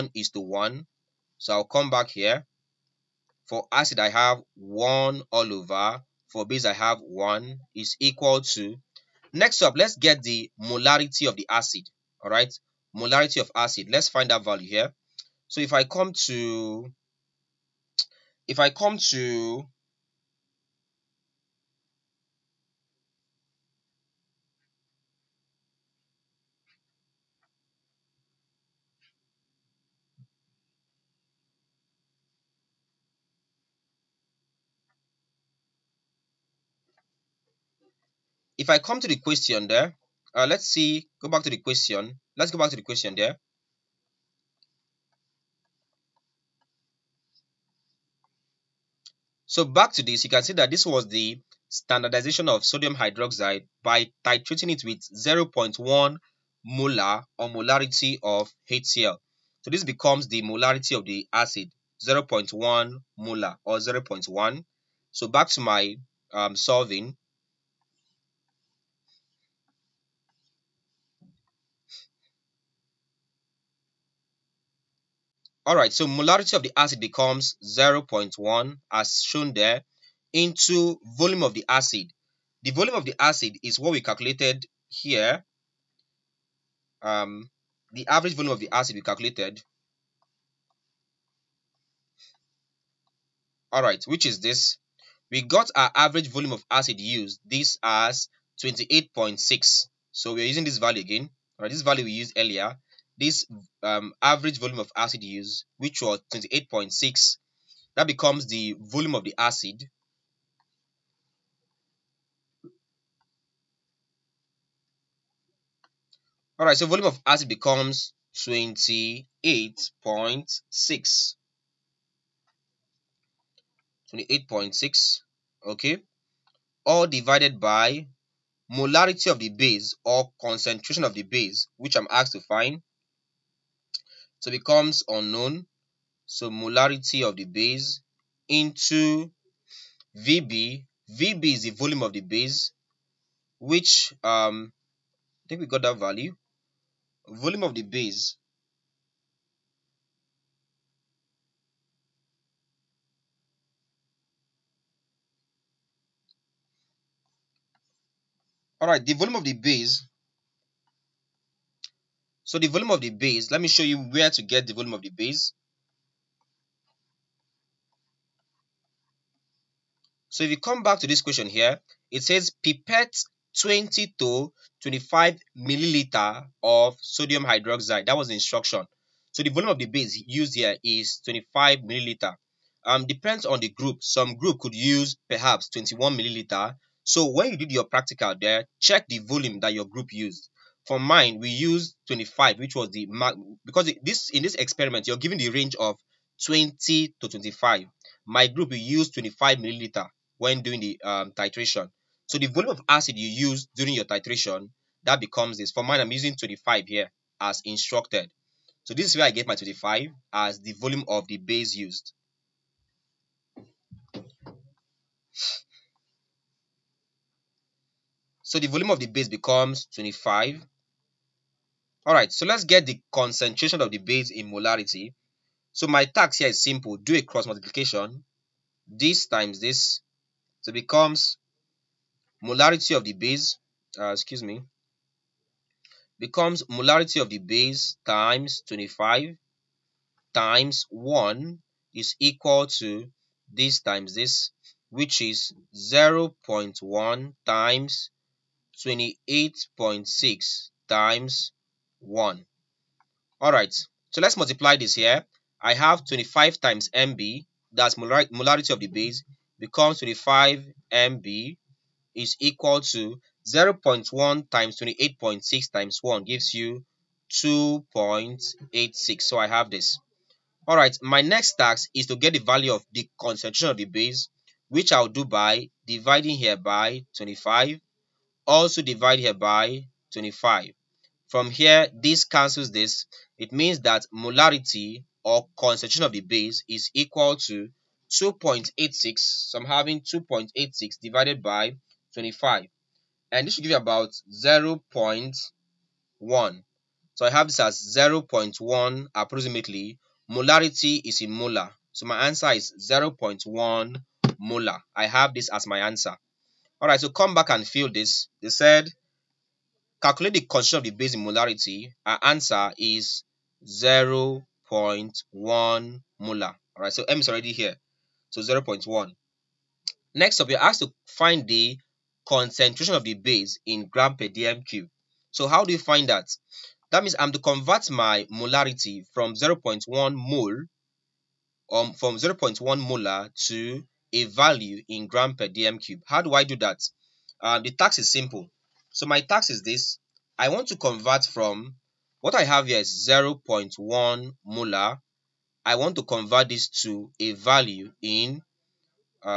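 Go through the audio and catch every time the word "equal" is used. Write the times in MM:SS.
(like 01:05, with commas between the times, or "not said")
00:07, 04:02, 04:22, 04:46.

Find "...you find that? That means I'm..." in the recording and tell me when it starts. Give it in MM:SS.
05:25.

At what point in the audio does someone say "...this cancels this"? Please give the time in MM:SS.
04:41.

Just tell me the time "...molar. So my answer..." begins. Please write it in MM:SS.
05:01.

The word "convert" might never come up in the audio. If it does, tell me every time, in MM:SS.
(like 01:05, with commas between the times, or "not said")
05:27, 05:40, 05:46.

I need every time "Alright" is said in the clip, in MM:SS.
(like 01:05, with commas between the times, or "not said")
01:15, 01:33, 01:41, 01:56, 02:38, 04:13, 04:30, 05:06.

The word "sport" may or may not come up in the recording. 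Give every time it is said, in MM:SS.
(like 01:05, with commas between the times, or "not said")
not said.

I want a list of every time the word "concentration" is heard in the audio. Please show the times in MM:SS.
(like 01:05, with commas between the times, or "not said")
02:10, 03:43, 04:33, 04:45, 05:10, 05:22.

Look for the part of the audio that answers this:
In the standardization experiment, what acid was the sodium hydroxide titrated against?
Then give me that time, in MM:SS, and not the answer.
00:58.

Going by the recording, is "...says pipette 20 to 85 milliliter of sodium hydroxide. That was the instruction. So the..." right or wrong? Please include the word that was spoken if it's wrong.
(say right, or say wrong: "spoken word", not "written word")
wrong: "25", not "85".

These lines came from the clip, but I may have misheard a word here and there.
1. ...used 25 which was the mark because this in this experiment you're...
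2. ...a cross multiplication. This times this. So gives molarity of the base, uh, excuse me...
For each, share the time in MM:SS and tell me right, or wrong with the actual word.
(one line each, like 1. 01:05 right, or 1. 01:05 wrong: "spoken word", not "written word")
1. 03:11 right
2. 03:47 wrong: "becomes", not "gives".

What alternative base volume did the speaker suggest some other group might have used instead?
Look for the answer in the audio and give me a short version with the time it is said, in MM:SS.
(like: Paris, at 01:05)
21 milliliter, at 03:05.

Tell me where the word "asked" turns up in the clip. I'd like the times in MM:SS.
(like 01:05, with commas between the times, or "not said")
02:12, 05:20.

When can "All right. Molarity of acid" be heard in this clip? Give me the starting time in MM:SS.
00:12.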